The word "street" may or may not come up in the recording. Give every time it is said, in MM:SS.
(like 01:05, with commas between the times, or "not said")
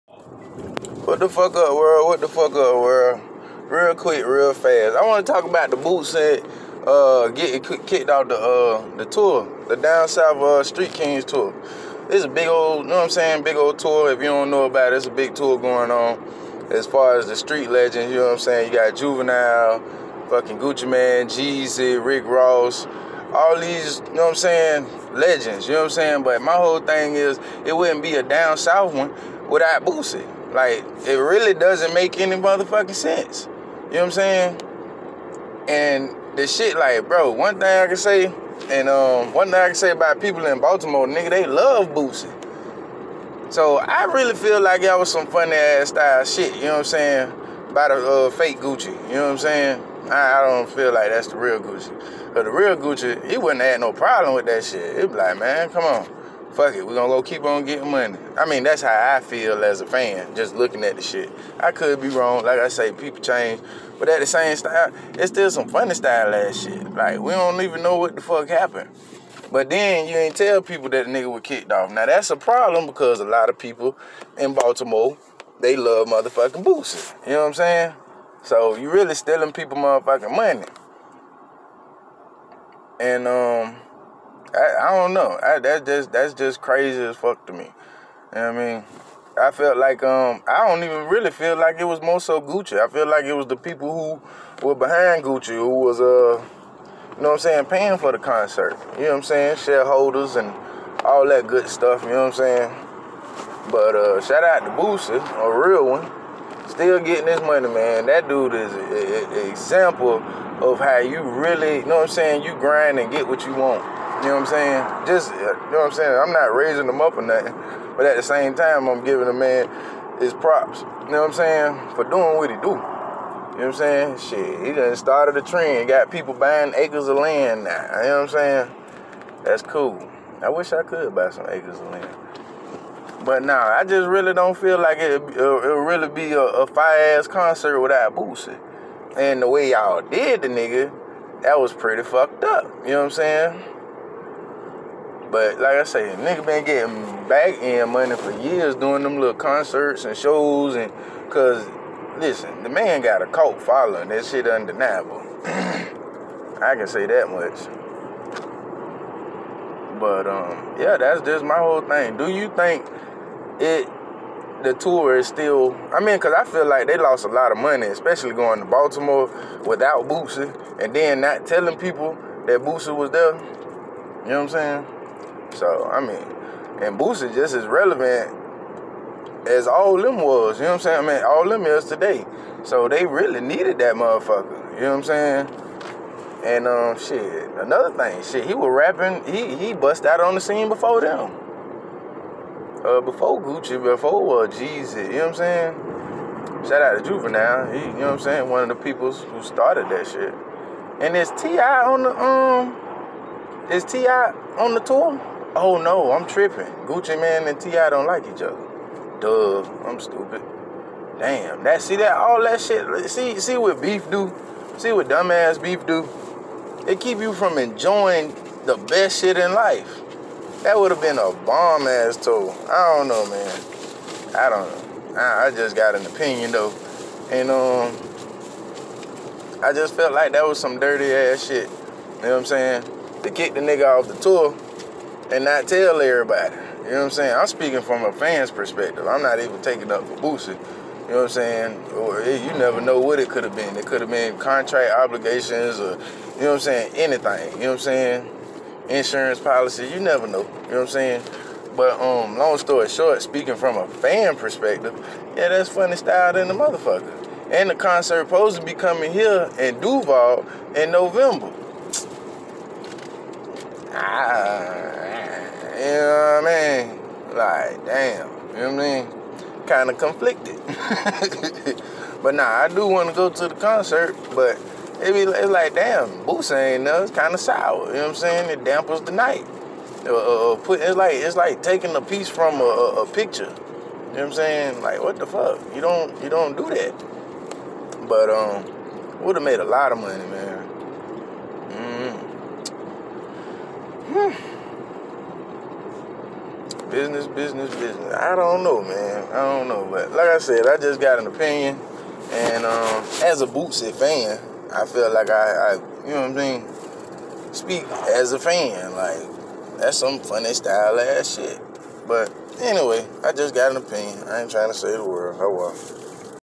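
00:10, 00:17.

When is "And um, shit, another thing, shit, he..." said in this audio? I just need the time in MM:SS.
03:06.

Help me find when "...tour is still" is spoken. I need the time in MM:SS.
02:44.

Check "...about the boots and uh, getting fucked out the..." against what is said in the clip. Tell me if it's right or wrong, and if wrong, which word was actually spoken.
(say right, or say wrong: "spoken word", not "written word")
wrong: "kicked", not "fucked".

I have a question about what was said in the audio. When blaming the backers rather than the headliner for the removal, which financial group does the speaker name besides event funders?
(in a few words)
Shareholders.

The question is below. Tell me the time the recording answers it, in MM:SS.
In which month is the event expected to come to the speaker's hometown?
04:20.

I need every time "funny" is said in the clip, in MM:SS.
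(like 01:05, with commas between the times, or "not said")
00:45, 01:05, 04:15, 05:10.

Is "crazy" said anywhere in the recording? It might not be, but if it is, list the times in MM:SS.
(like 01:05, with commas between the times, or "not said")
01:26.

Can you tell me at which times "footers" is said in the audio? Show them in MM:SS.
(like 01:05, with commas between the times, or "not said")
not said.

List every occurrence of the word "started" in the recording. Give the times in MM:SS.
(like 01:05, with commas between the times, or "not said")
02:04, 03:19.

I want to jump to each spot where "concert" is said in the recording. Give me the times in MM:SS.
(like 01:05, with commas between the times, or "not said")
01:38, 02:17, 02:29, 04:17, 04:33.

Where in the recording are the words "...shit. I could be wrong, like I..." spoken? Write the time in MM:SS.
01:01.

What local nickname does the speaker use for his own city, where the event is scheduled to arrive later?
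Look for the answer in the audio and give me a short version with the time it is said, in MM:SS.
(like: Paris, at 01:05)
Duval, at 04:19.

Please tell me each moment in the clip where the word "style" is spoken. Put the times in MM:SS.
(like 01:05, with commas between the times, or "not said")
00:45, 01:05, 04:15, 05:10.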